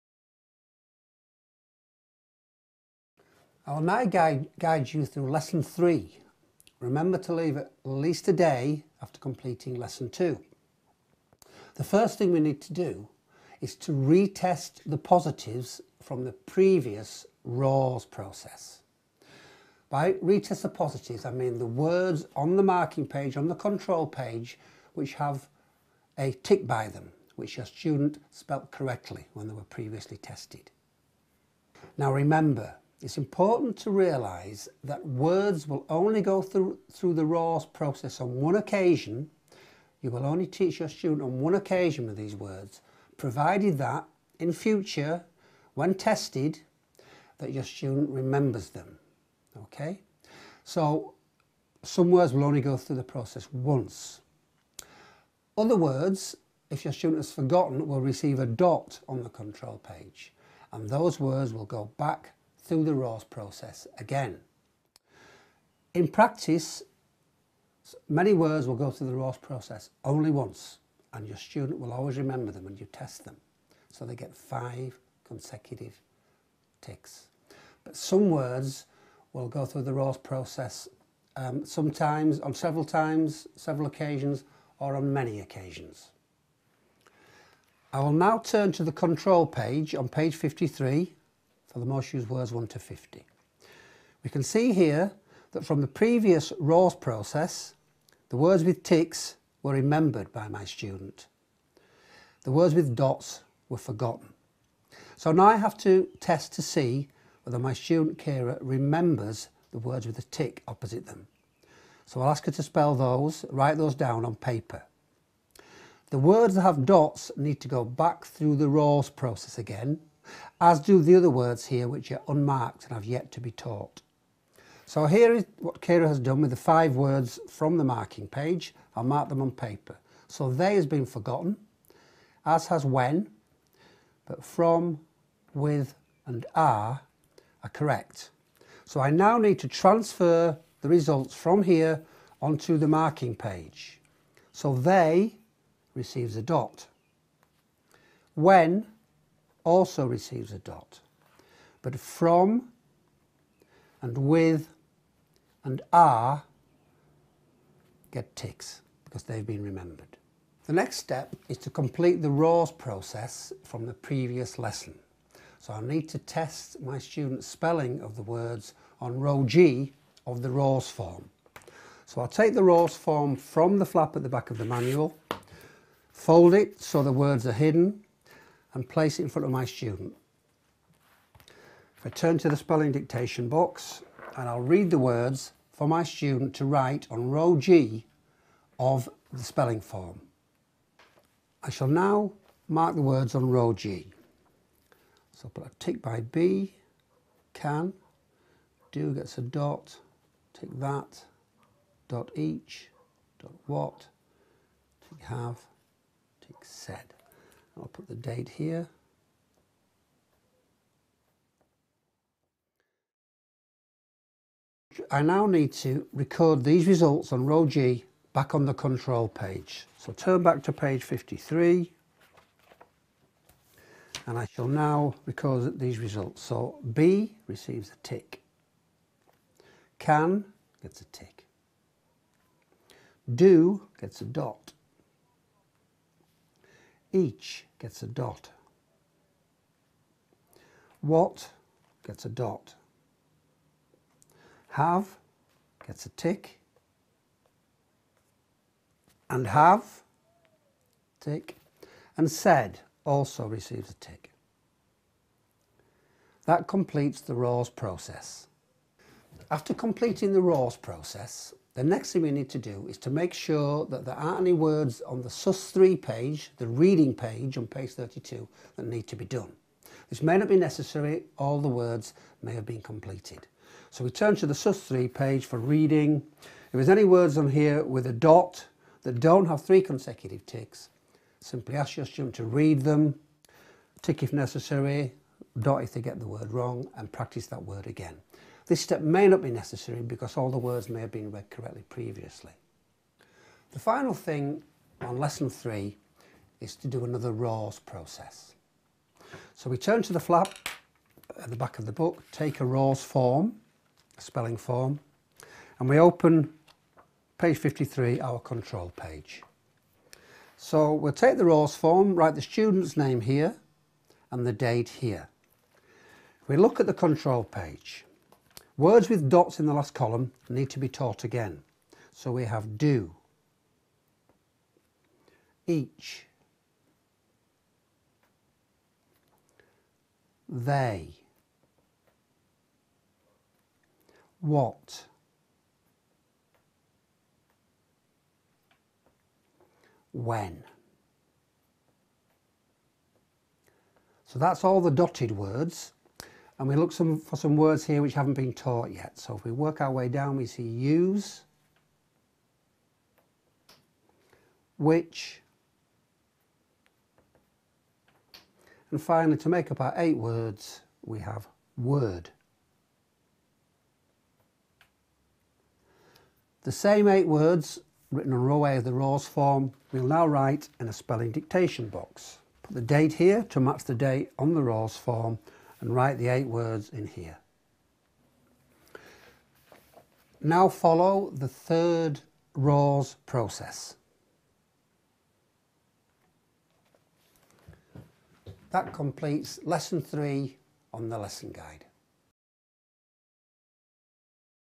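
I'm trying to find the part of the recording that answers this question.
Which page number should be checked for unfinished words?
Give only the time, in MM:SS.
04:27.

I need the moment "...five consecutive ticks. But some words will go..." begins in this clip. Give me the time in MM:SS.
01:14.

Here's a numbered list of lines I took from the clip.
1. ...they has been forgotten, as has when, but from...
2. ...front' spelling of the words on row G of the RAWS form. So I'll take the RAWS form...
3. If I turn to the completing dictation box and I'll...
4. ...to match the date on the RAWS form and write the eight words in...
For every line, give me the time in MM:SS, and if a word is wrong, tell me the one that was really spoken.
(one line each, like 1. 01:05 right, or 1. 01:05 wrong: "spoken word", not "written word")
1. 02:10 right
2. 02:46 wrong: "students", not "front"
3. 03:01 wrong: "spelling", not "completing"
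4. 06:13 right.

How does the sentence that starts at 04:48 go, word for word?
This step may not be necessary because all the words may have been read correctly previously.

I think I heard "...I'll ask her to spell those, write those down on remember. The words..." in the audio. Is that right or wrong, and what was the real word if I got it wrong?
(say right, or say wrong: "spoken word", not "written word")
wrong: "paper", not "remember".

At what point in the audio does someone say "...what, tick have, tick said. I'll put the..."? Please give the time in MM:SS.
03:23.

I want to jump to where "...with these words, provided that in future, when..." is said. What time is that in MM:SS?
00:42.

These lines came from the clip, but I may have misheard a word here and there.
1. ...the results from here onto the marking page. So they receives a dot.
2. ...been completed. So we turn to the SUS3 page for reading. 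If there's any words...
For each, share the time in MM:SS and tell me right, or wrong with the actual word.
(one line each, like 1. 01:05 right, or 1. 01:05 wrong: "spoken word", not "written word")
1. 02:20 right
2. 04:32 right.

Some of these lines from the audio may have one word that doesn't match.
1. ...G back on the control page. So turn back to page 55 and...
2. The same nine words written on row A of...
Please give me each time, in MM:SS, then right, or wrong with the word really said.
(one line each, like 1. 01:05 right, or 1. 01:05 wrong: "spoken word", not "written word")
1. 03:37 wrong: "53", not "55"
2. 06:06 wrong: "eight", not "nine".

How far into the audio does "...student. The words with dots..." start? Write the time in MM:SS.
01:40.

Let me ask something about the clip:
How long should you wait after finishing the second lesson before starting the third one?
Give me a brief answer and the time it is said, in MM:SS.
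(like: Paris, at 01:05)
At least a day, at 00:07.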